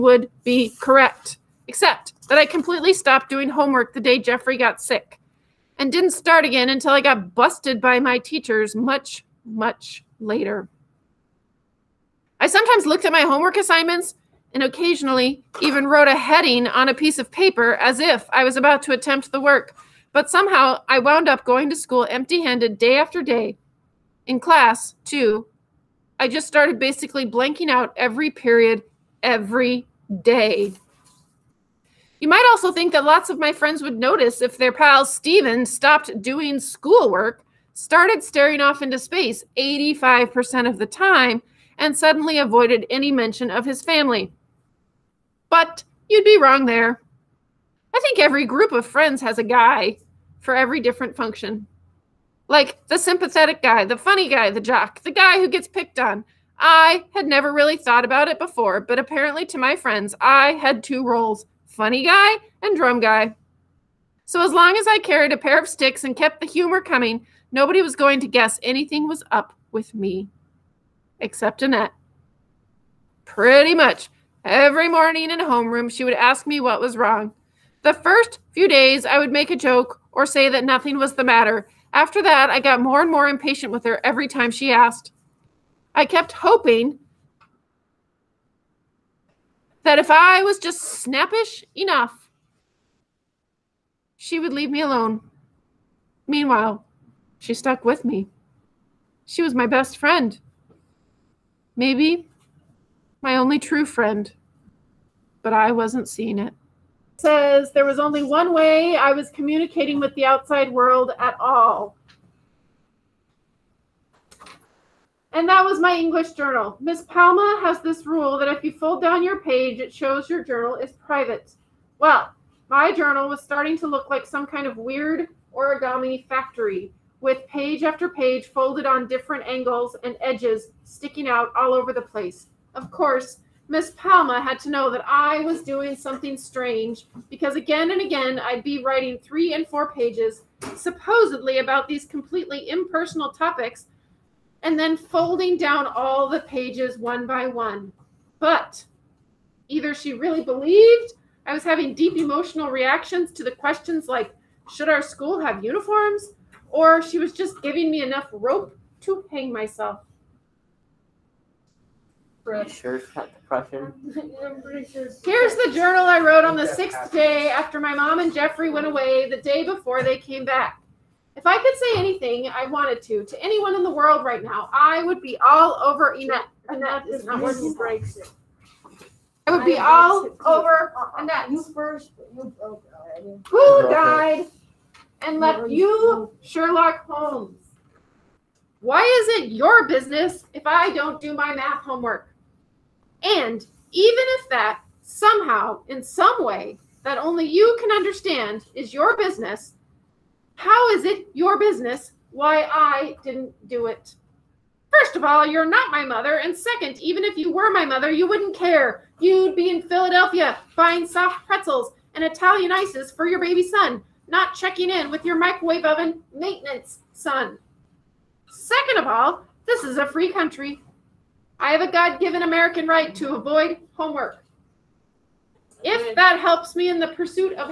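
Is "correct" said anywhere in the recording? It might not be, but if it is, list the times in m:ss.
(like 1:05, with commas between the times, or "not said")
0:00.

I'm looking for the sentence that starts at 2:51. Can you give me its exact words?
If I could say anything I wanted to to anyone in the world right now, I would be all over Annette.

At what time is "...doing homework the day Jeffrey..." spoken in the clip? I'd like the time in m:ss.
0:03.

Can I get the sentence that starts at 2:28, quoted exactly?
But either she really believed I was having deep emotional reactions to the questions like, should our school have uniforms?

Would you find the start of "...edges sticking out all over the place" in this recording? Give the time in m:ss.
2:10.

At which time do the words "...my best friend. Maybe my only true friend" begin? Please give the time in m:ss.
1:39.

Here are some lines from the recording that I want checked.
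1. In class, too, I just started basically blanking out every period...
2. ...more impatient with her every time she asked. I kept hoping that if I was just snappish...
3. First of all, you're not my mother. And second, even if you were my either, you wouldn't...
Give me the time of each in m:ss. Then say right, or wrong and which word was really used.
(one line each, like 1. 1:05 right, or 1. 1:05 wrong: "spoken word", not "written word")
1. 0:24 right
2. 1:23 right
3. 3:24 wrong: "mother", not "either".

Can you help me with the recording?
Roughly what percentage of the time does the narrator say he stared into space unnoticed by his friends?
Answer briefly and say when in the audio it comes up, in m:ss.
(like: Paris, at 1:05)
85%, at 0:39.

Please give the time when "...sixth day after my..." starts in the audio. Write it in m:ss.
2:46.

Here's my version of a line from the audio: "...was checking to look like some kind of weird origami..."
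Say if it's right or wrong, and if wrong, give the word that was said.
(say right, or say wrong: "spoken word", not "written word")
wrong: "starting", not "checking".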